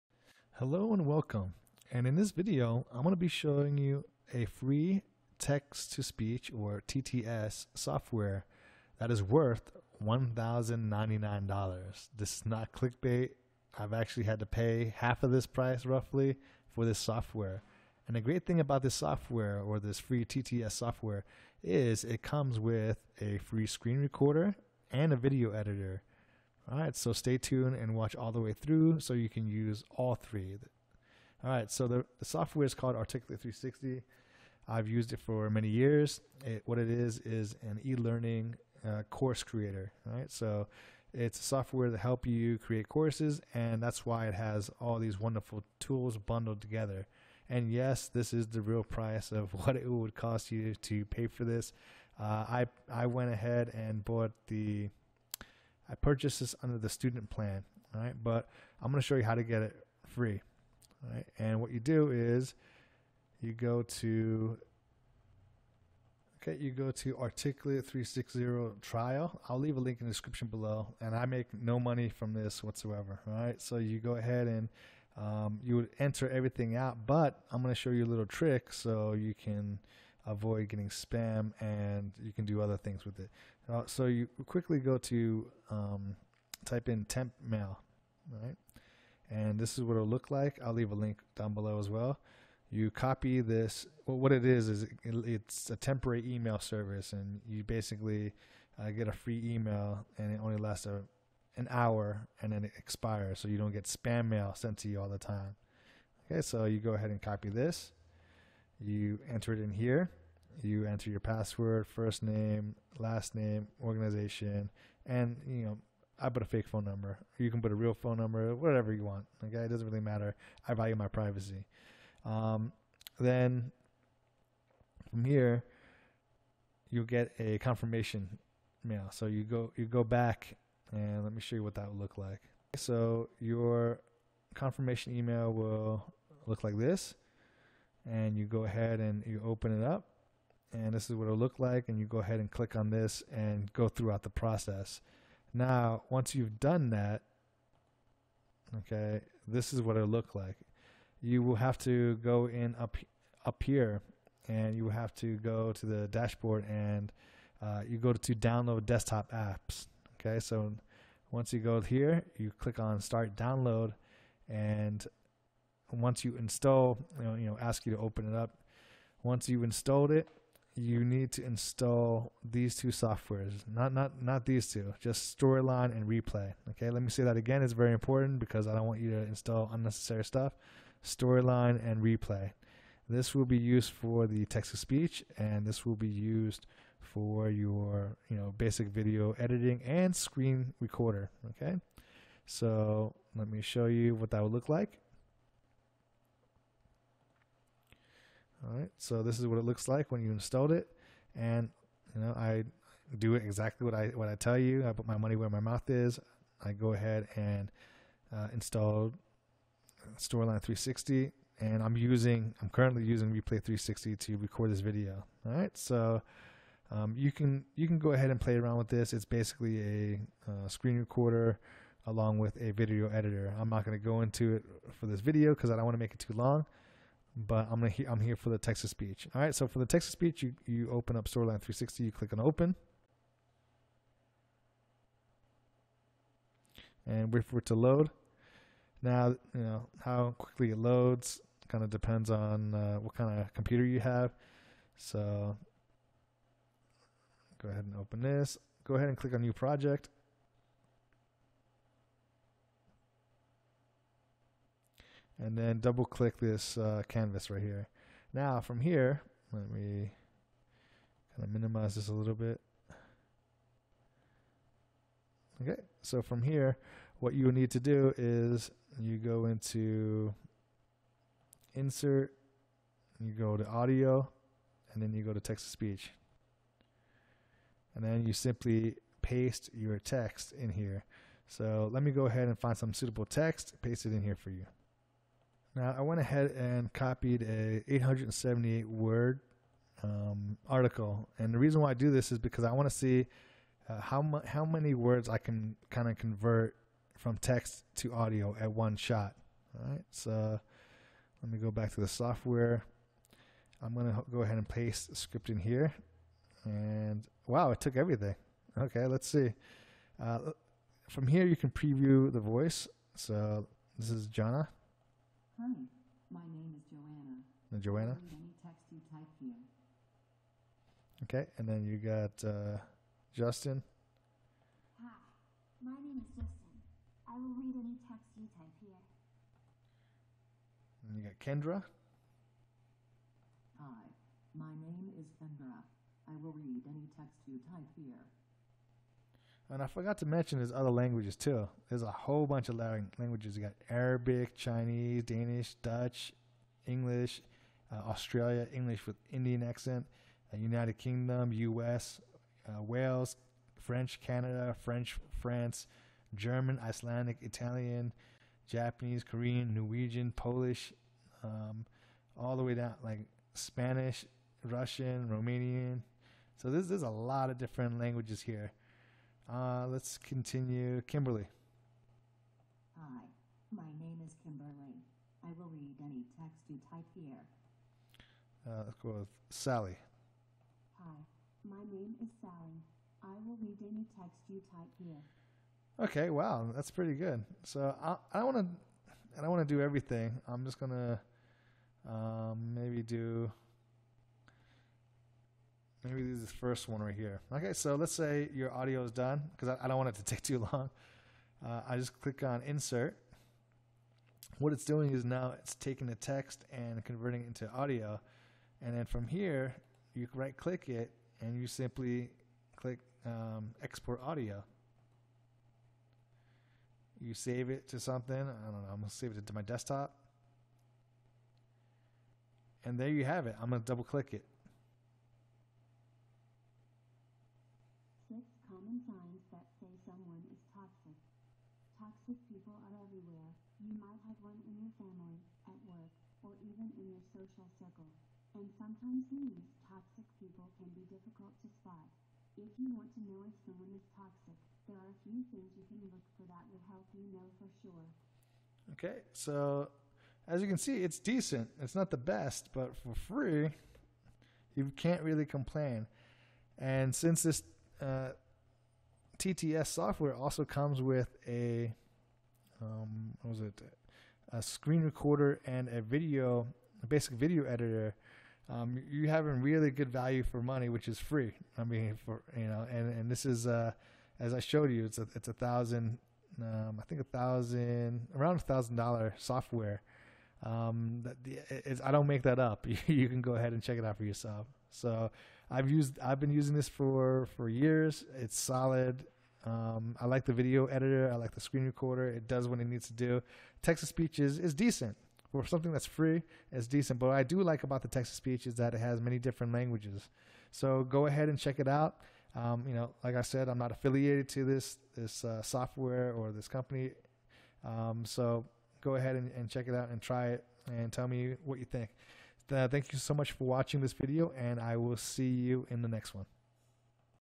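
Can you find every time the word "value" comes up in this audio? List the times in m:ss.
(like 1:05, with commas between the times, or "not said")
2:00, 7:50.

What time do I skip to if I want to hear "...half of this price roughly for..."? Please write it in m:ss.
0:14.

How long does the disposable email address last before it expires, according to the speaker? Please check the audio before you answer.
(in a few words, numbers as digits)
an hour.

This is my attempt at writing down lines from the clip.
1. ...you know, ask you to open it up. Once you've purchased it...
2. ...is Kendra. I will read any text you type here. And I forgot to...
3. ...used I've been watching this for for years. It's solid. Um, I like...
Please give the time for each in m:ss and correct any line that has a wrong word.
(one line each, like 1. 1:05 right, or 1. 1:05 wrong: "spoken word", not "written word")
1. 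2:47 wrong: "installed", not "purchased"
2. 5:35 right
3. 8:05 wrong: "using", not "watching".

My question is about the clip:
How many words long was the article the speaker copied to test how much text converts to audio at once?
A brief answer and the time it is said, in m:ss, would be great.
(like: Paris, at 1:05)
878, at 4:47.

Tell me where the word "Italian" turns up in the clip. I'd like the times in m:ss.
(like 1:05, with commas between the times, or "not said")
5:57.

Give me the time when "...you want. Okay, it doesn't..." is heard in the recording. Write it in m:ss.
1:58.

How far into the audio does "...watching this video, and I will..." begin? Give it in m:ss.
8:33.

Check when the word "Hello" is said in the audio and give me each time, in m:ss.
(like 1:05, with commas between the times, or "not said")
0:00.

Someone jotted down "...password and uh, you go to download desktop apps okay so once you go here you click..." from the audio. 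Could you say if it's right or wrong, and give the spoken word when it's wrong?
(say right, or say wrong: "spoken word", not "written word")
wrong: "dashboard", not "password".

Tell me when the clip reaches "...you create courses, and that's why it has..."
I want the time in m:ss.
0:42.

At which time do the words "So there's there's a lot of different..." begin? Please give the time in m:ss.
6:06.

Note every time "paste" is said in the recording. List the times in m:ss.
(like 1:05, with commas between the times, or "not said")
4:39, 4:43, 5:04.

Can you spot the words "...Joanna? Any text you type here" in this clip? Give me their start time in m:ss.
5:17.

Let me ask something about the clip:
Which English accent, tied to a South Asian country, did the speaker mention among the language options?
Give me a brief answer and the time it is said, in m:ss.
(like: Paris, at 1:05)
Indian accent, at 5:49.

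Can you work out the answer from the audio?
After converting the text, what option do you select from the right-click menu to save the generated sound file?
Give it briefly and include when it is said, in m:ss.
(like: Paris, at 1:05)
export audio, at 6:53.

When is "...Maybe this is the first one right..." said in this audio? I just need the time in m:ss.
6:36.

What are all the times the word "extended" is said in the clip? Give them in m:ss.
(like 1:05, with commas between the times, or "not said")
not said.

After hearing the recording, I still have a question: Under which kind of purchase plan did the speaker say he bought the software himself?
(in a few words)
student plan.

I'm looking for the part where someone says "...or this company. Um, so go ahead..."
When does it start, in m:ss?
8:26.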